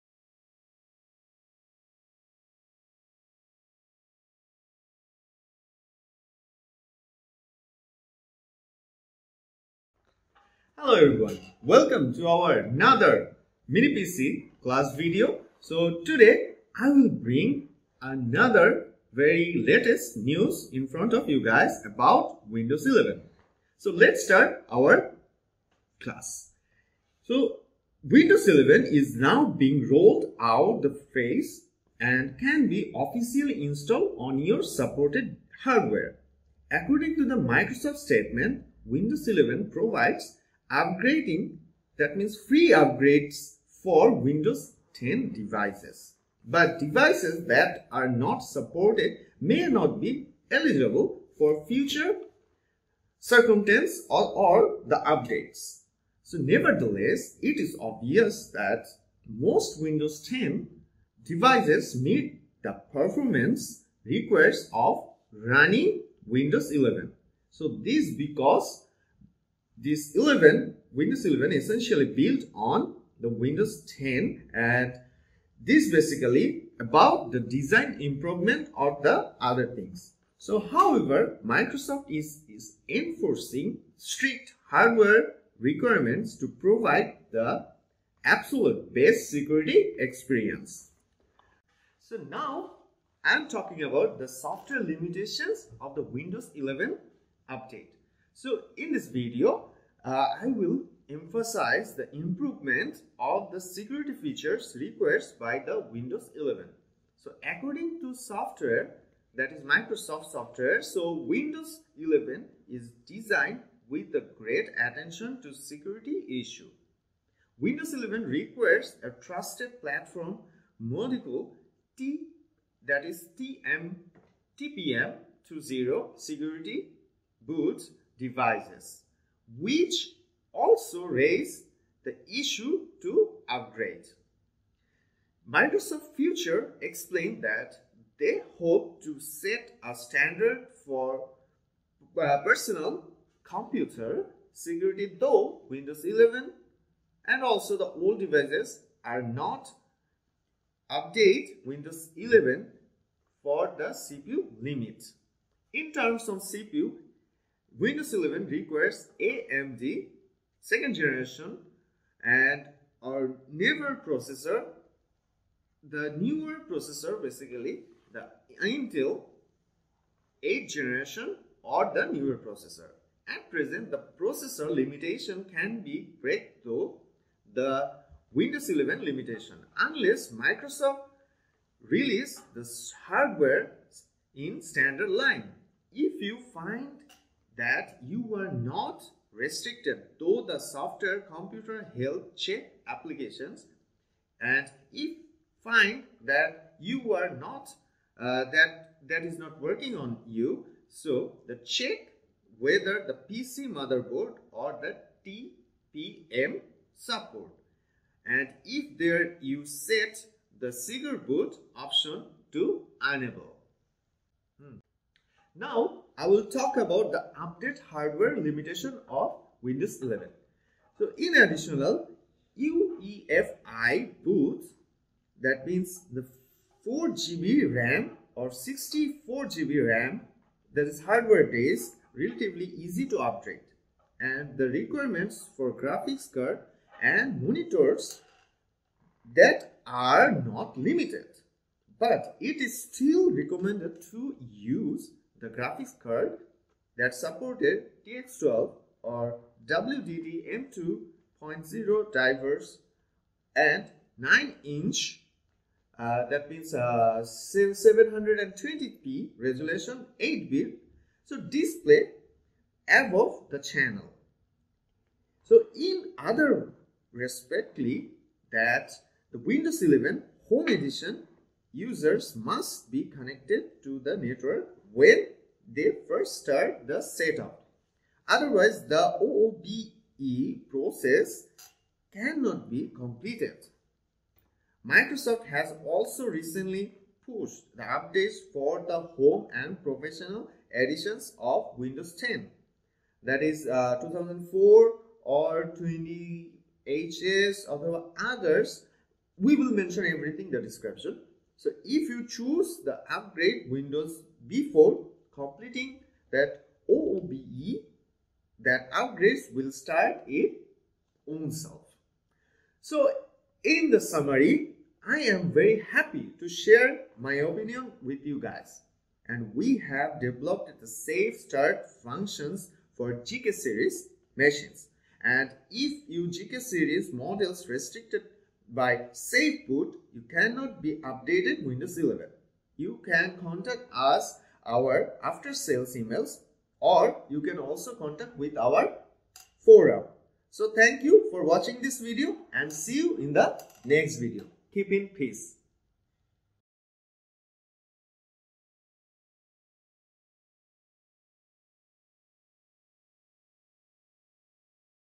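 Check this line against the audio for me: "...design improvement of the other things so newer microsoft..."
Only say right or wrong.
wrong.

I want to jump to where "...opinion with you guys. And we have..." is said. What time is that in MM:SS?
05:17.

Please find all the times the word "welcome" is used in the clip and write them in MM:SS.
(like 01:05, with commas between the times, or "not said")
00:11.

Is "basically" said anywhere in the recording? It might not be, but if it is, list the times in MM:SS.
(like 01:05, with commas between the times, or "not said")
01:15, 02:47.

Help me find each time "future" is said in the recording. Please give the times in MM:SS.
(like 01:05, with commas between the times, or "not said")
00:51, 02:16.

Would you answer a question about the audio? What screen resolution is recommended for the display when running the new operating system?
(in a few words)
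720p.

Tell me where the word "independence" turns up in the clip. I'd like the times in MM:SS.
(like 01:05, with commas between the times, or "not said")
not said.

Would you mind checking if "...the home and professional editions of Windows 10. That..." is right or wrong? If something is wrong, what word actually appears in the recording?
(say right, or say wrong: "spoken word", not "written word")
right.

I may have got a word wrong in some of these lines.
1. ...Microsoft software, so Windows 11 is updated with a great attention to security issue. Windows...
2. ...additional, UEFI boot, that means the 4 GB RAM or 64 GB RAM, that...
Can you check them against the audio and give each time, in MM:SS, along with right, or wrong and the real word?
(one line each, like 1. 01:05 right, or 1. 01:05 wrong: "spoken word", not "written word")
1. 01:49 wrong: "designed", not "updated"
2. 03:41 right.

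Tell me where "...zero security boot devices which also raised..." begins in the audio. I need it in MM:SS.
02:05.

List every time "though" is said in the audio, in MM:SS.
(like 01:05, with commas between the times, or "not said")
02:25, 03:10.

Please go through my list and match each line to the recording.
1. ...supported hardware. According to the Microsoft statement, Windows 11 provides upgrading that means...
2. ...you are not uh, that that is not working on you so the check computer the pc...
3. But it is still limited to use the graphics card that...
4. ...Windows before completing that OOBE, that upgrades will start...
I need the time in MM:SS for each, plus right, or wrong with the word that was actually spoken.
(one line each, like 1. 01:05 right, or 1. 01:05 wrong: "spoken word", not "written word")
1. 00:34 right
2. 03:16 wrong: "whether", not "computer"
3. 04:01 wrong: "recommended", not "limited"
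4. 05:03 right.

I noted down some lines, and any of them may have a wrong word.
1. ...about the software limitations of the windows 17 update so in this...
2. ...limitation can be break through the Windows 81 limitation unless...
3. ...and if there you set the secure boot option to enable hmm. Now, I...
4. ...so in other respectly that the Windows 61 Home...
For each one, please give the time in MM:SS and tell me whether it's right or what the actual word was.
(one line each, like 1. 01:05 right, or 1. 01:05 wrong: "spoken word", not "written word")
1. 01:33 wrong: "11", not "17"
2. 02:54 wrong: "11", not "81"
3. 03:28 right
4. 04:25 wrong: "11", not "61".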